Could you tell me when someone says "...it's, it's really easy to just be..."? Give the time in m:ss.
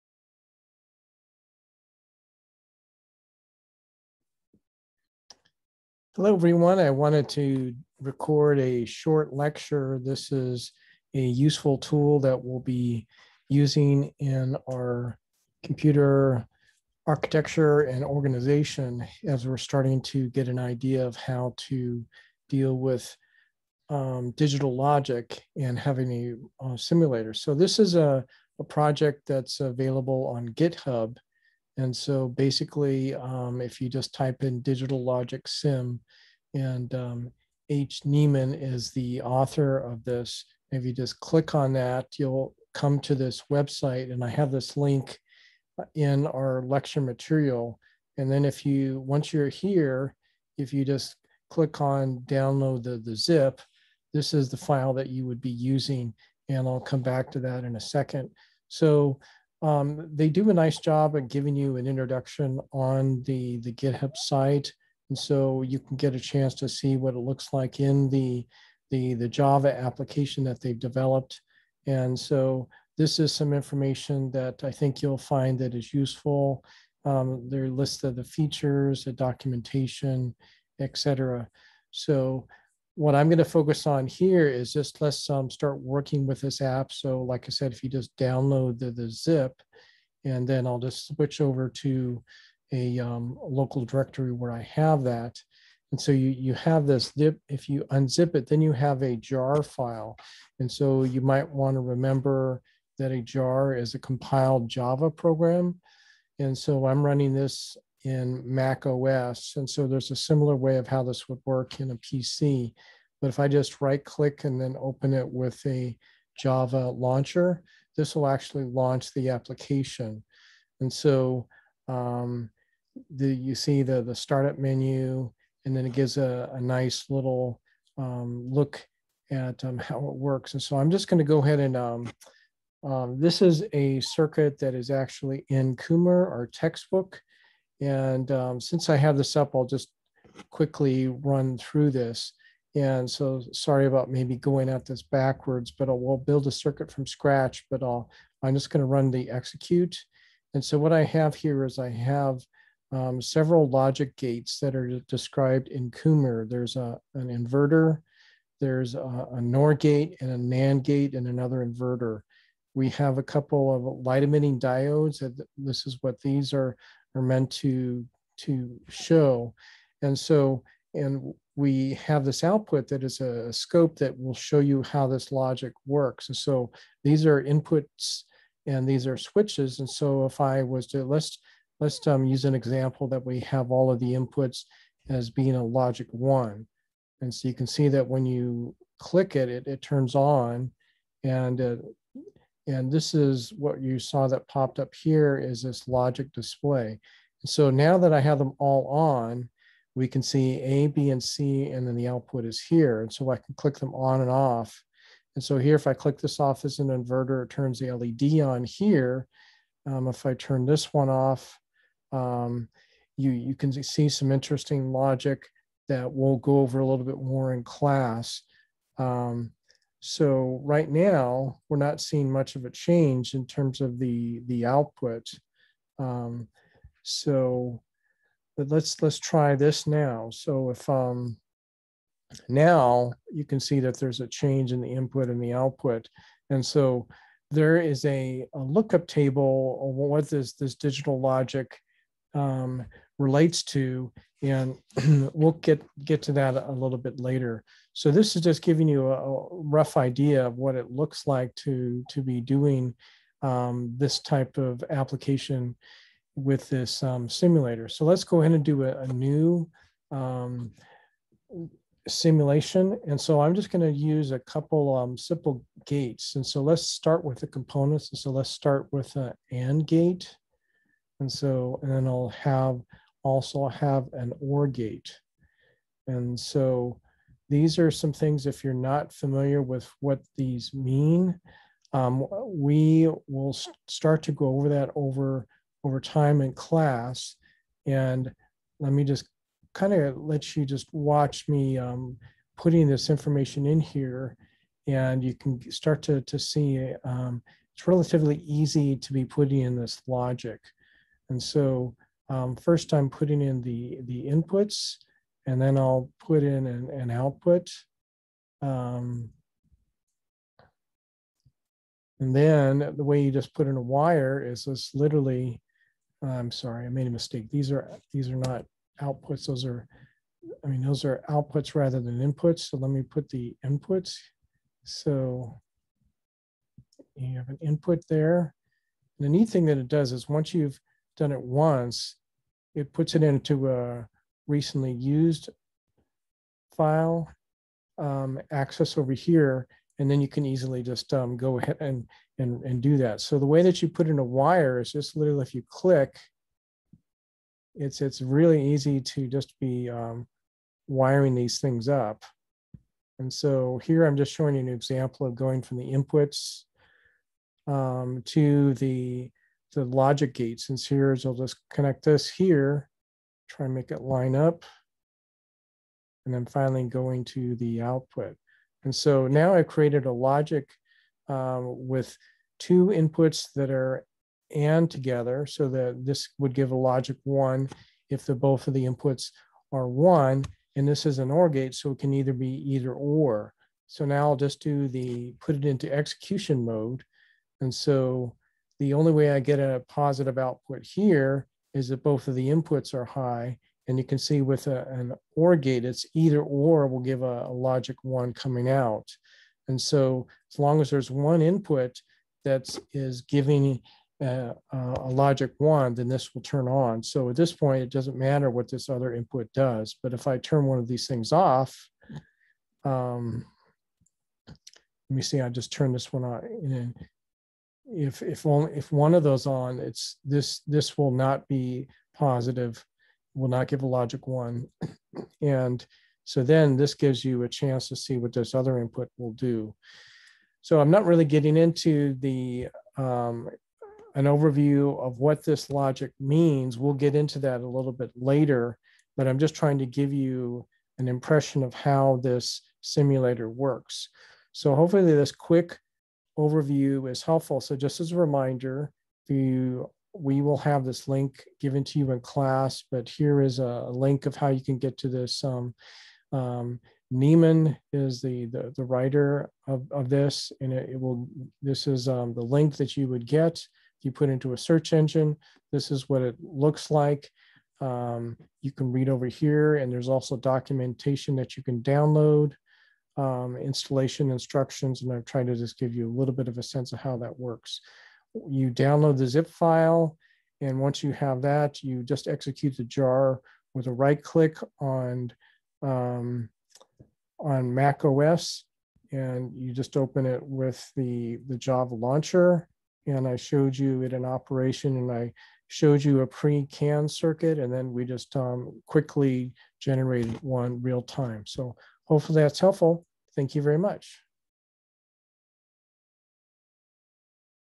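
5:47.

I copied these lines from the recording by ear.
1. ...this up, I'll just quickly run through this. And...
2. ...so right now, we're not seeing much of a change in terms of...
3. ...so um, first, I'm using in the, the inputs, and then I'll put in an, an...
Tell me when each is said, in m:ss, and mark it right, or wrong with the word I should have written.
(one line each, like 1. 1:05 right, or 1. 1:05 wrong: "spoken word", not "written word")
1. 2:19 right
2. 3:40 right
3. 5:01 wrong: "putting", not "using".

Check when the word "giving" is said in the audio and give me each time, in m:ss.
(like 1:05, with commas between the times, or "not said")
1:01, 4:08, 6:43.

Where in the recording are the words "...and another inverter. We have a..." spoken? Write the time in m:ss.
2:41.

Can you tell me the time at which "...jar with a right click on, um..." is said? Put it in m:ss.
8:02.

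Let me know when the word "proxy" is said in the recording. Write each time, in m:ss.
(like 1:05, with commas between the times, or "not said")
not said.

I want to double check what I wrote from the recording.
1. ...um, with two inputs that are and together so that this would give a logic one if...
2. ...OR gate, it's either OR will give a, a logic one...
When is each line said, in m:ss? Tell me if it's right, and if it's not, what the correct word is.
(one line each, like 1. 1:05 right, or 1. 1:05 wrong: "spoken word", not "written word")
1. 6:11 right
2. 6:35 right.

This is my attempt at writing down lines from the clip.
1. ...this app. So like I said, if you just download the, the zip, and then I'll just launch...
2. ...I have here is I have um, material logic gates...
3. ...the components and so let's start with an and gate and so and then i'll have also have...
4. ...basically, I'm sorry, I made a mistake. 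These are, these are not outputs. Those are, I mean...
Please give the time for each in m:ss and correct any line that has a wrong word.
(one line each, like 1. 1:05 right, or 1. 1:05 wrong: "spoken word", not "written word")
1. 1:26 wrong: "switch", not "launch"
2. 2:30 wrong: "several", not "material"
3. 4:27 right
4. 5:14 wrong: "literally", not "basically".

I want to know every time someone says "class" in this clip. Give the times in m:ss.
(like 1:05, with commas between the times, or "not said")
3:37, 4:46, 7:32.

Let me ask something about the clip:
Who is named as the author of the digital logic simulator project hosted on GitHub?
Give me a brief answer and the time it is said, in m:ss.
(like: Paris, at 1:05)
H. Neemann, at 0:37.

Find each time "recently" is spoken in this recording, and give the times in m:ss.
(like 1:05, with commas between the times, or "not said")
5:34.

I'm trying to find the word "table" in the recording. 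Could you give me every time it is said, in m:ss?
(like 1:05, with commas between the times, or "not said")
3:59.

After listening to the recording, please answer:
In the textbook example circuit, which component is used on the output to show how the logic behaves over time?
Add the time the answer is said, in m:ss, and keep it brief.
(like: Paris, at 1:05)
a scope, at 2:53.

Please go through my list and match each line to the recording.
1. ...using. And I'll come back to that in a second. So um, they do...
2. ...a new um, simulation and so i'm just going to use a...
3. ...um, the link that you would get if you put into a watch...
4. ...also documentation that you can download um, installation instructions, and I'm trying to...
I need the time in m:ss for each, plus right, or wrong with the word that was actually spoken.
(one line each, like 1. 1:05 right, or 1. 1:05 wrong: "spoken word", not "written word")
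1. 0:55 right
2. 4:19 right
3. 7:42 wrong: "search", not "watch"
4. 7:50 right.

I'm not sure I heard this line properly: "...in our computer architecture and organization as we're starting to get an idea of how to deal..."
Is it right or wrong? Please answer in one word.
right.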